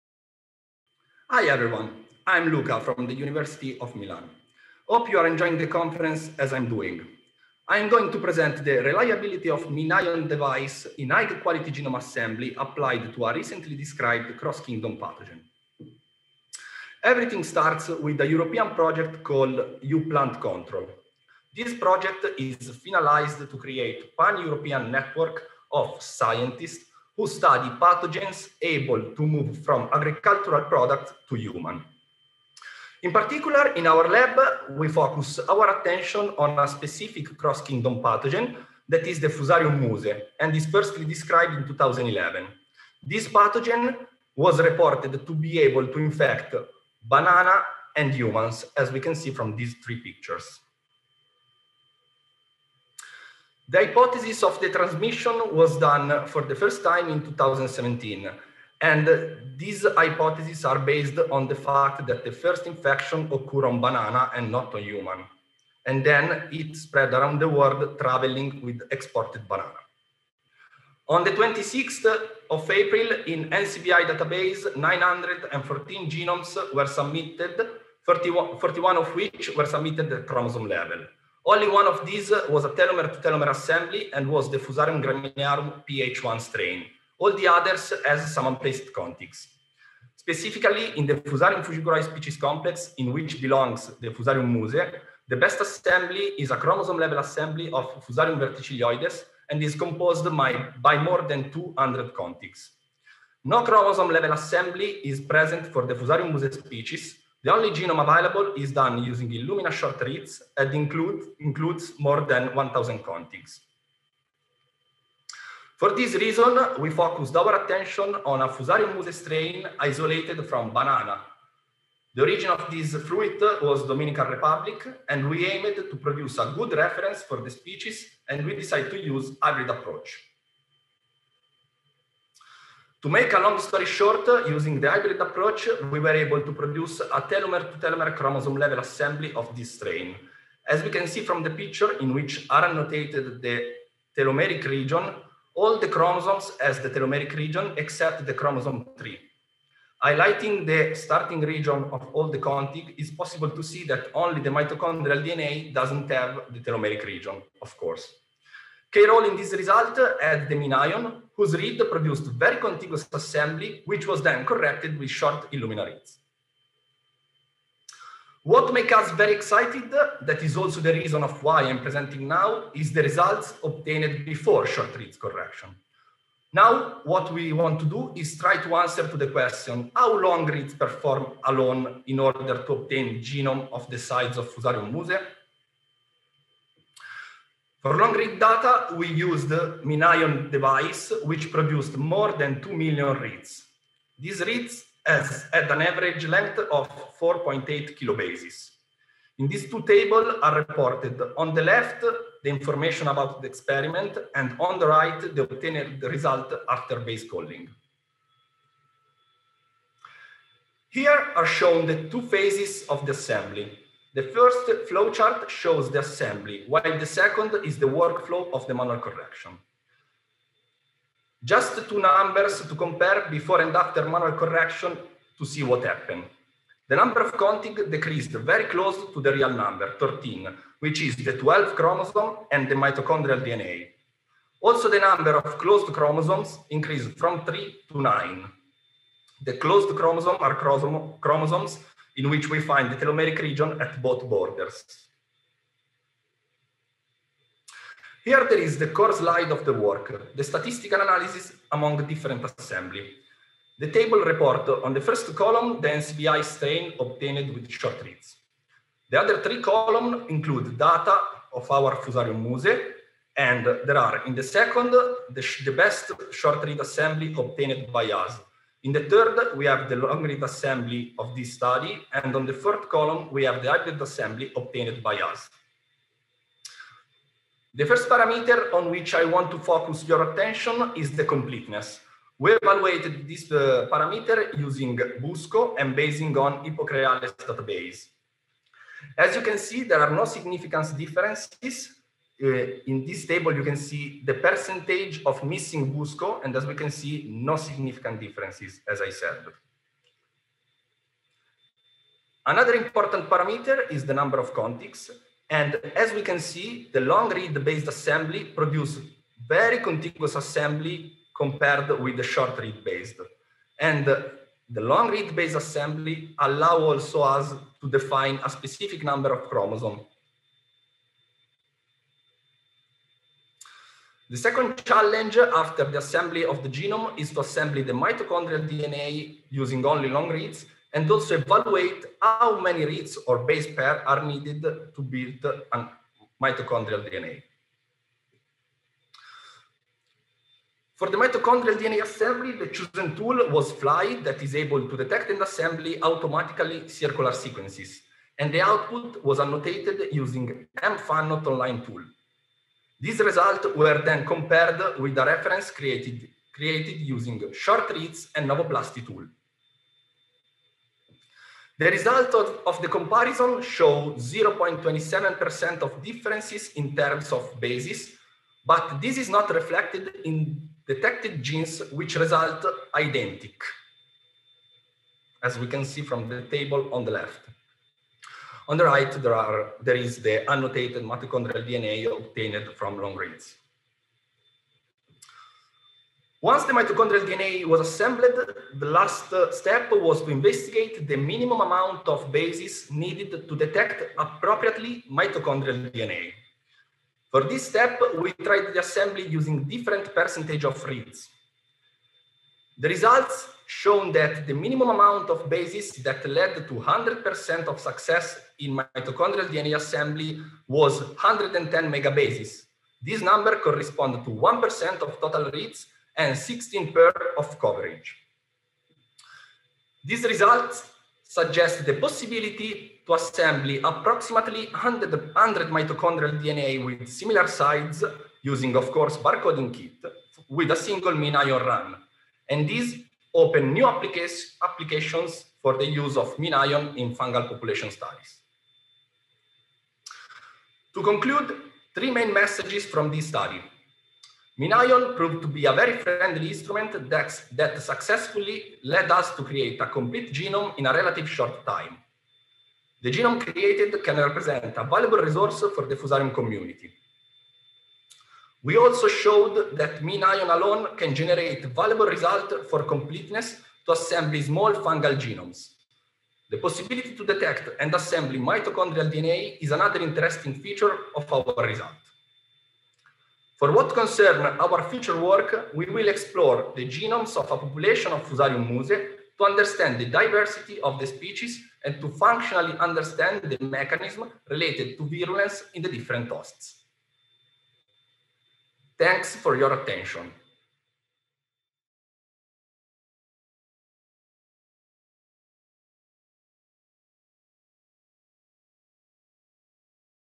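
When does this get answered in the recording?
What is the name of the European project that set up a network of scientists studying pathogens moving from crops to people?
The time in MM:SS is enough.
00:19.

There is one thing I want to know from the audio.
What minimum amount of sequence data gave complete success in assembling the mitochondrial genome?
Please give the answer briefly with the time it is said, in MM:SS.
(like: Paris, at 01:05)
110 megabases, at 06:51.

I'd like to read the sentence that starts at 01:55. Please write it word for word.
For this reason, we focused our attention on a Fusarium musae strain isolated from banana.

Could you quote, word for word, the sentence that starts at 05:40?
For the mitochondrial DNA assembly, the chosen tool was Flye that is able to detect and assemble automatically circular sequences.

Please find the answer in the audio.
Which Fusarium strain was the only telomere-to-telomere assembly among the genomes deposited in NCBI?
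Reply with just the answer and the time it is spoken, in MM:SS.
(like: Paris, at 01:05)
PH1, at 01:25.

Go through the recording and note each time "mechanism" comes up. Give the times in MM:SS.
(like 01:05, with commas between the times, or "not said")
08:03.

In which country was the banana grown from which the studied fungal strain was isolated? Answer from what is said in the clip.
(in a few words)
Dominican Republic.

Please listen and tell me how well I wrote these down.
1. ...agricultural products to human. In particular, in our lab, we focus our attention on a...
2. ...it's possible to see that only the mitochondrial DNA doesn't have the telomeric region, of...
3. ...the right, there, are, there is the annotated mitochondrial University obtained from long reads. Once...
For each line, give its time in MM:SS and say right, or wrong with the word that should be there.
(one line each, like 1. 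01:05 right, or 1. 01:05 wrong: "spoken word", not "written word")
1. 00:29 right
2. 02:32 right
3. 06:18 wrong: "DNA", not "University".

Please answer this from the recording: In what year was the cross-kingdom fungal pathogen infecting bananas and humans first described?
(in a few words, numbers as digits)
2011.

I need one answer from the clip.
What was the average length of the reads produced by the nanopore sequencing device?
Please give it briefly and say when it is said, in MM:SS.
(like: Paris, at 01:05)
4.8 kilobases, at 03:17.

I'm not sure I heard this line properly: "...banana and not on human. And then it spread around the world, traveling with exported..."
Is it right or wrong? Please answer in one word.
right.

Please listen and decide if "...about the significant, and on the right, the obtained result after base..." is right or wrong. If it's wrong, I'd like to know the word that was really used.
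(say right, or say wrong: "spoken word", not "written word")
wrong: "experiment", not "significant".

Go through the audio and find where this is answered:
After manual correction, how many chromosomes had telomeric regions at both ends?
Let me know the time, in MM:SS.
03:57.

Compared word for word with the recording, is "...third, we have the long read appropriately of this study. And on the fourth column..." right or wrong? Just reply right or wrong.
wrong.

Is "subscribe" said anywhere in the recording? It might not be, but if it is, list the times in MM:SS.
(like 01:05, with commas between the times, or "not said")
not said.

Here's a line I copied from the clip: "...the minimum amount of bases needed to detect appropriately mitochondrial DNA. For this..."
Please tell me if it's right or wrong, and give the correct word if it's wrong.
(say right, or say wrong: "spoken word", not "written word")
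right.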